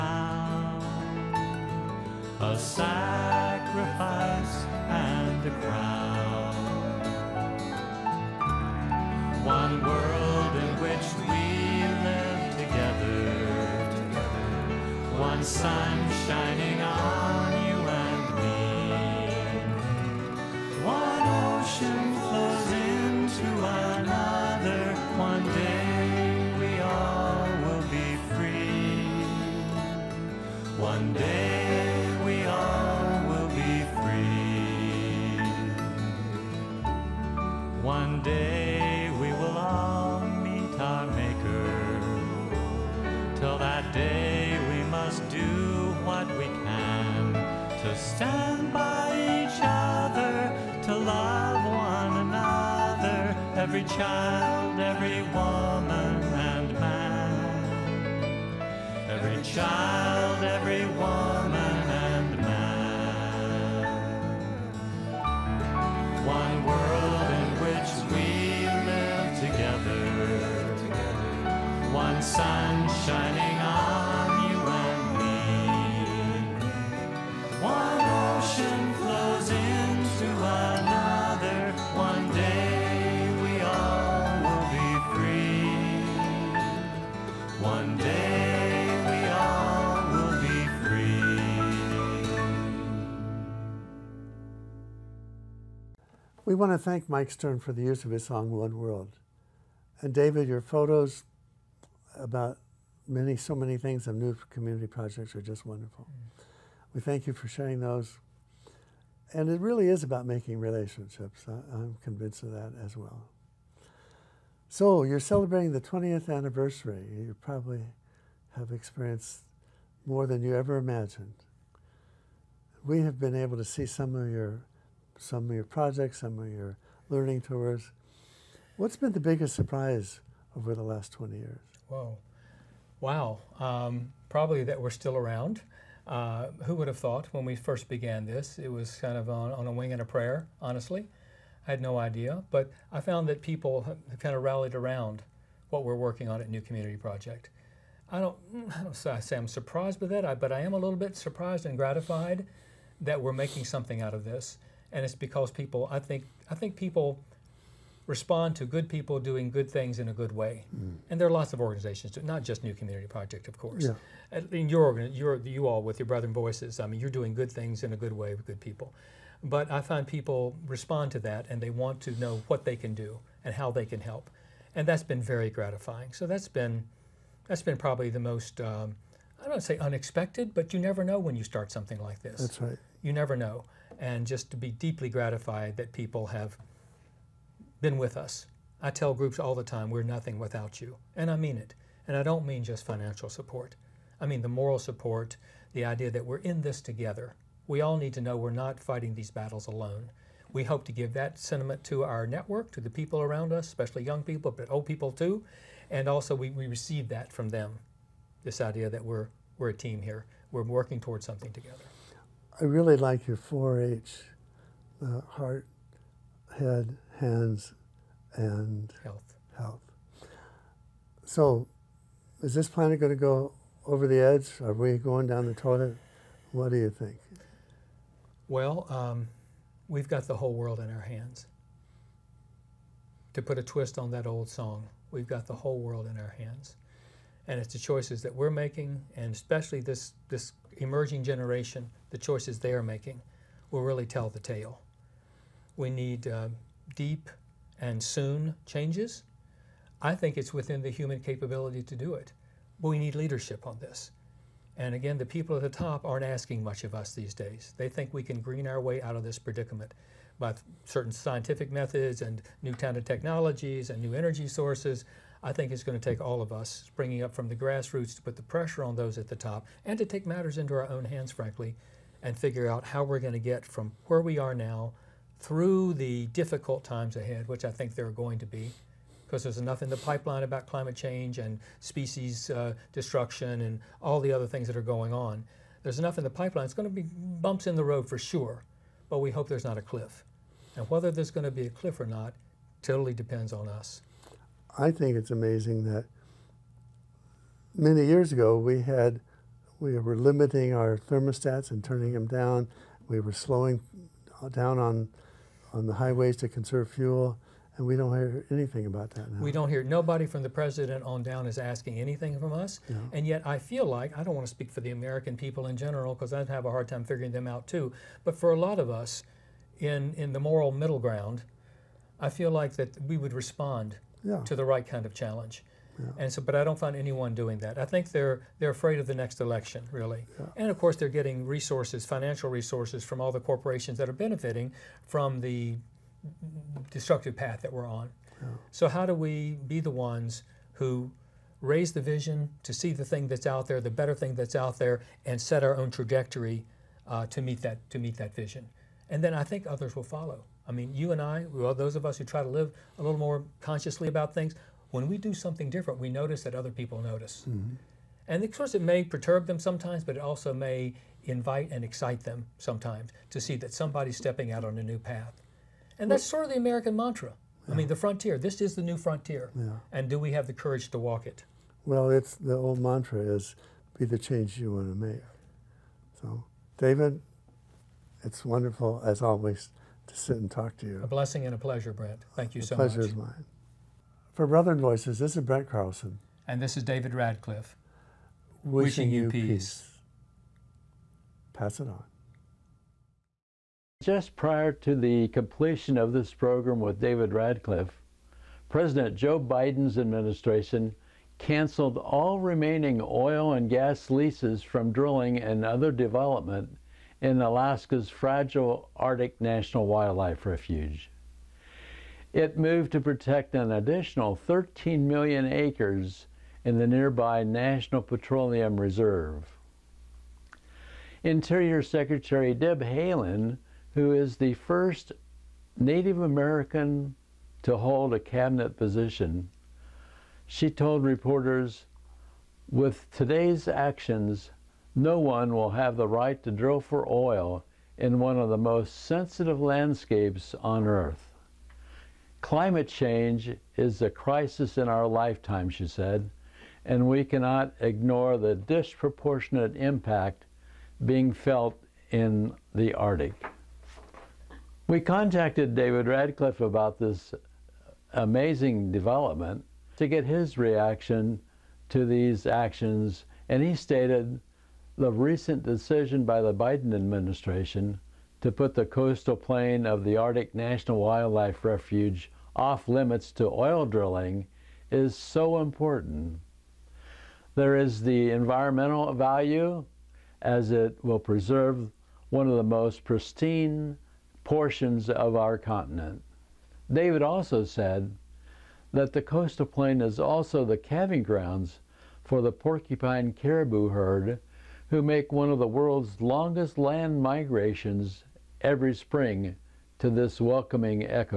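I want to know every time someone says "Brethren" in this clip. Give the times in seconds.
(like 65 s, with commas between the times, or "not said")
166 s, 384 s.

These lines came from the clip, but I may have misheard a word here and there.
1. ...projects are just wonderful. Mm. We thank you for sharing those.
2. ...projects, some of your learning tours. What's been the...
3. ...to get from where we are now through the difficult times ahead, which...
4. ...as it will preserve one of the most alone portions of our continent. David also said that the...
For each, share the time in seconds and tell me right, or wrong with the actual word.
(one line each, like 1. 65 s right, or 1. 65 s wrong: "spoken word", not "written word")
1. 104 s right
2. 125 s right
3. 273 s right
4. 480 s wrong: "pristine", not "alone".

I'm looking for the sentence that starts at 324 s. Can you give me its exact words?
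to the right kind of challenge.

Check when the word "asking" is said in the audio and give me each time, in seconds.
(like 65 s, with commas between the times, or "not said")
256 s, 311 s.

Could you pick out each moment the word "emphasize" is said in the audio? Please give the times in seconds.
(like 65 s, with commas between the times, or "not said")
not said.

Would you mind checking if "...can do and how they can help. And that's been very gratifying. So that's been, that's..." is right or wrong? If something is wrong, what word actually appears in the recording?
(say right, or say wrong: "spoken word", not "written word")
right.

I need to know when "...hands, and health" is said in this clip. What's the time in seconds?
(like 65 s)
217 s.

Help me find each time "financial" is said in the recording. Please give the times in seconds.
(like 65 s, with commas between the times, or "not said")
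192 s, 332 s.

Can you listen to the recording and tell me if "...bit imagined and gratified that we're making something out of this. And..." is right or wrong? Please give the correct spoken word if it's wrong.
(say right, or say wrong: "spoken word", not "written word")
wrong: "surprised", not "imagined".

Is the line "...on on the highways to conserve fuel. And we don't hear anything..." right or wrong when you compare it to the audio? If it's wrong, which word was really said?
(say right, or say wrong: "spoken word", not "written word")
right.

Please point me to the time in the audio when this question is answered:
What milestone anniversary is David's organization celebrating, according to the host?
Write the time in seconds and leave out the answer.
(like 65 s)
115 s.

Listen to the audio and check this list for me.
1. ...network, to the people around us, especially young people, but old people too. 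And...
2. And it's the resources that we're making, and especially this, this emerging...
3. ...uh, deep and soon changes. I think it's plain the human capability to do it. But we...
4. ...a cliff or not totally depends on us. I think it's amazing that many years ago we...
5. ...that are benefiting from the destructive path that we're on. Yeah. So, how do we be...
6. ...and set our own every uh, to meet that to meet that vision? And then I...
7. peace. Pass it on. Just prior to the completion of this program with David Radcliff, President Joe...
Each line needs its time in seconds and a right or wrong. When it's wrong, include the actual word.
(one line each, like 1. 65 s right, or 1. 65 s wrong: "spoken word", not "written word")
1. 202 s right
2. 237 s wrong: "choices", not "resources"
3. 246 s wrong: "within", not "plain"
4. 291 s right
5. 333 s right
6. 345 s wrong: "trajectory", not "every"
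7. 389 s right.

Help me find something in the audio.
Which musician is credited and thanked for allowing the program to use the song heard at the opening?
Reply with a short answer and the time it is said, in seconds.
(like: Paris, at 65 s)
Mike Stern, at 97 s.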